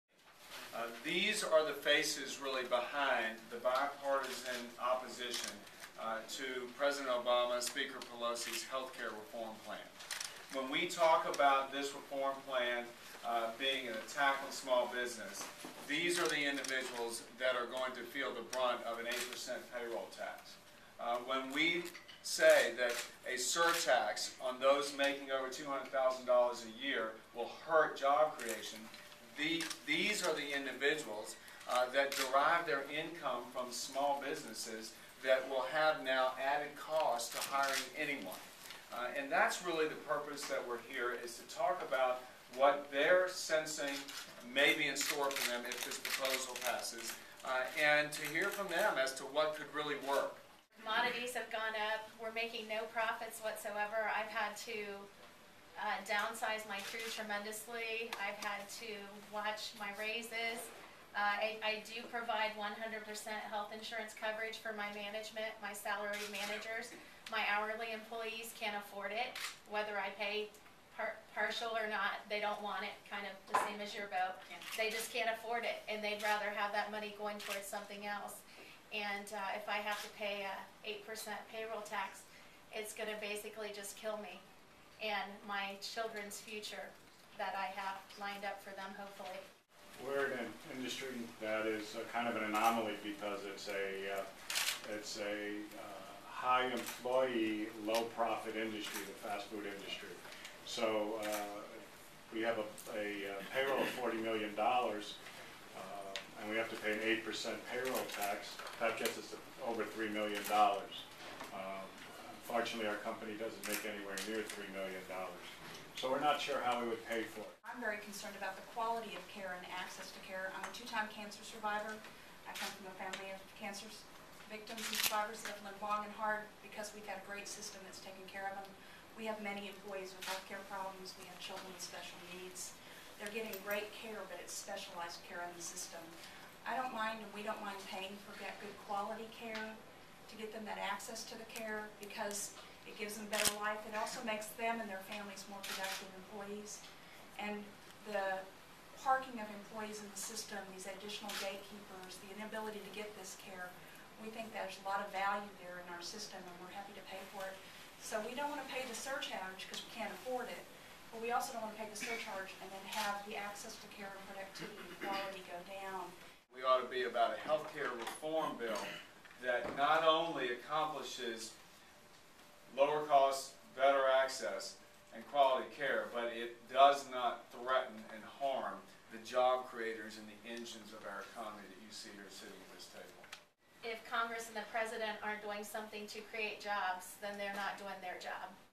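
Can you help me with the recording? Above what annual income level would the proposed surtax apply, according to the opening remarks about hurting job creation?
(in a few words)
$200,000.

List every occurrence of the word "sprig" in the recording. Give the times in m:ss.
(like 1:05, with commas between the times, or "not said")
not said.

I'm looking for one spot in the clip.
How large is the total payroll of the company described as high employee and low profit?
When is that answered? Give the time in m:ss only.
1:43.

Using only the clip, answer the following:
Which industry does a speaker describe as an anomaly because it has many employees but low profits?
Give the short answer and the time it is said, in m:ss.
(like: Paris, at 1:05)
Fast food industry, at 1:39.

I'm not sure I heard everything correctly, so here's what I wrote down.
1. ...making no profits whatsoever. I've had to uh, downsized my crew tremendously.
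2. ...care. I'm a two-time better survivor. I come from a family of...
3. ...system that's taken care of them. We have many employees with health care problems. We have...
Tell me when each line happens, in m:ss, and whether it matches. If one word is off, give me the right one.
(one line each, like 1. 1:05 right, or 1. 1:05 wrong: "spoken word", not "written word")
1. 0:52 right
2. 2:00 wrong: "cancer", not "better"
3. 2:07 right.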